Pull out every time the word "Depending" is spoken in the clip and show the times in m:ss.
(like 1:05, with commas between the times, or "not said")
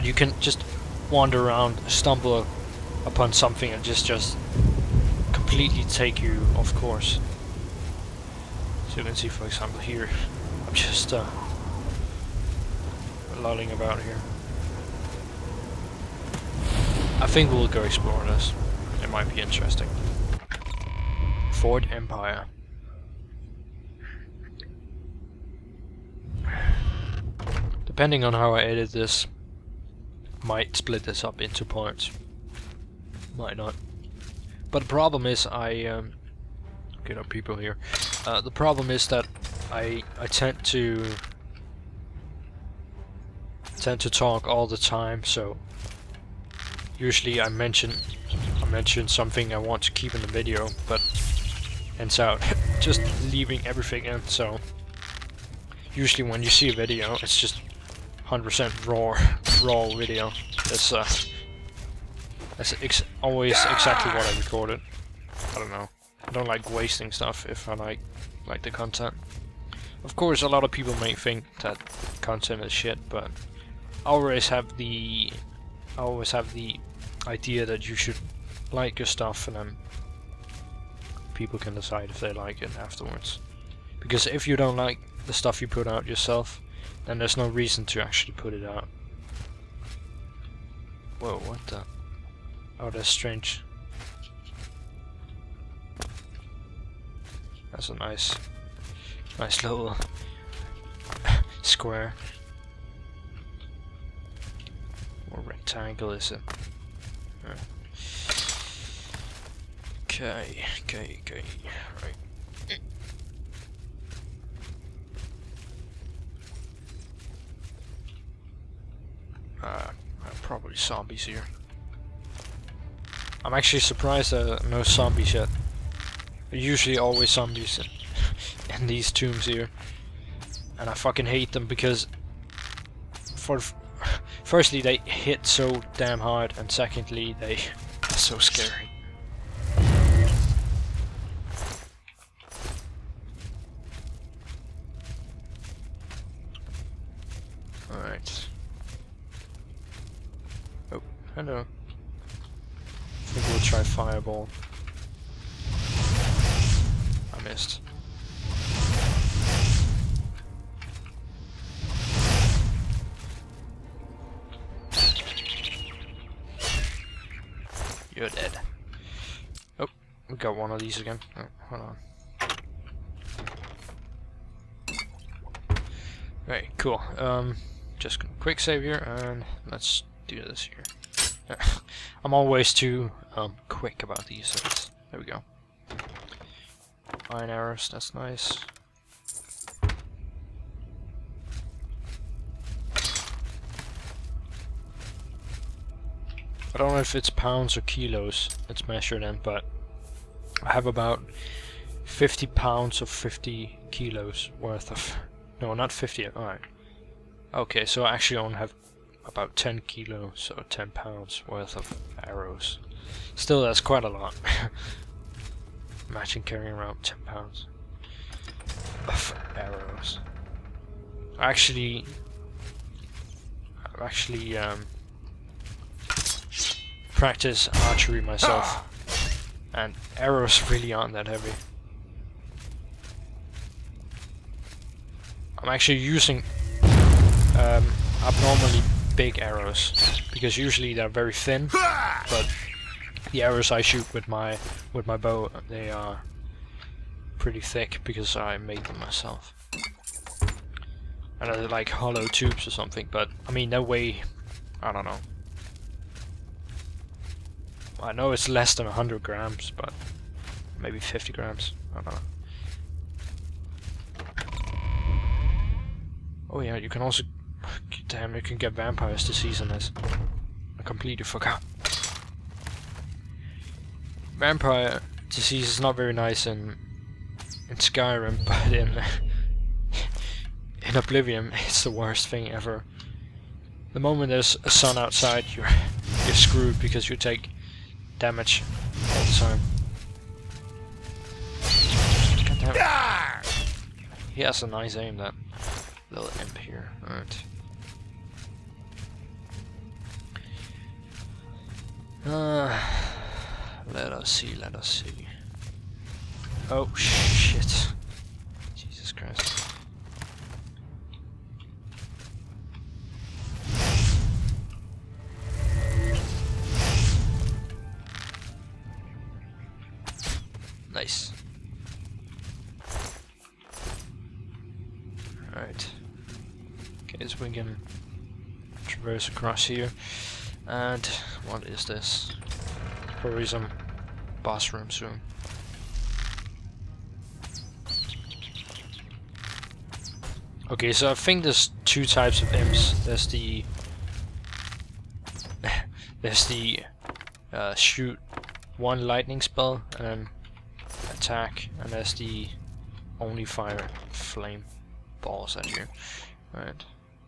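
0:27.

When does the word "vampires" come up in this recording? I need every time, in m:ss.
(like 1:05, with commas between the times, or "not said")
4:28, 4:34.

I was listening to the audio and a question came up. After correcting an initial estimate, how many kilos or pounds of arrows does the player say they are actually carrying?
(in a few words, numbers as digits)
10.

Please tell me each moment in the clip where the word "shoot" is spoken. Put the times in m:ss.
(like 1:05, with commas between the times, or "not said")
4:03, 5:47.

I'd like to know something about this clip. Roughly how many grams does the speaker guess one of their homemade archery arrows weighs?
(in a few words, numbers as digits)
50 grams.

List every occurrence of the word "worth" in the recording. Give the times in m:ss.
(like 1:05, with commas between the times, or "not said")
3:24, 3:31.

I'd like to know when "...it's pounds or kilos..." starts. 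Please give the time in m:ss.
3:17.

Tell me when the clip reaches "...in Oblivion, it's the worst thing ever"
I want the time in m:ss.
4:40.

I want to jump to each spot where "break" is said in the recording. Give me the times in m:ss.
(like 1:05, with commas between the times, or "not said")
not said.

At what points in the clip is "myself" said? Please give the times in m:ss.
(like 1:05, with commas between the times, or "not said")
3:48, 4:08.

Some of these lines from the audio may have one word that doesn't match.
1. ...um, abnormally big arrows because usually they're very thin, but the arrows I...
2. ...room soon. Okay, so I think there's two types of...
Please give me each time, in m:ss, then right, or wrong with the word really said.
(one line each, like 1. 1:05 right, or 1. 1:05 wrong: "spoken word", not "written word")
1. 3:57 right
2. 5:34 right.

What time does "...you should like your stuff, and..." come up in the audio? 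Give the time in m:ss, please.
1:17.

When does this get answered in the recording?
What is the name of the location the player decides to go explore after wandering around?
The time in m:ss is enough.
0:21.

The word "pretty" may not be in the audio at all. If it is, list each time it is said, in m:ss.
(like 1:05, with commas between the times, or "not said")
4:07.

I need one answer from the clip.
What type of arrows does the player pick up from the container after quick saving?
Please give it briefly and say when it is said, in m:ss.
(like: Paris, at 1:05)
Iron arrows, at 3:07.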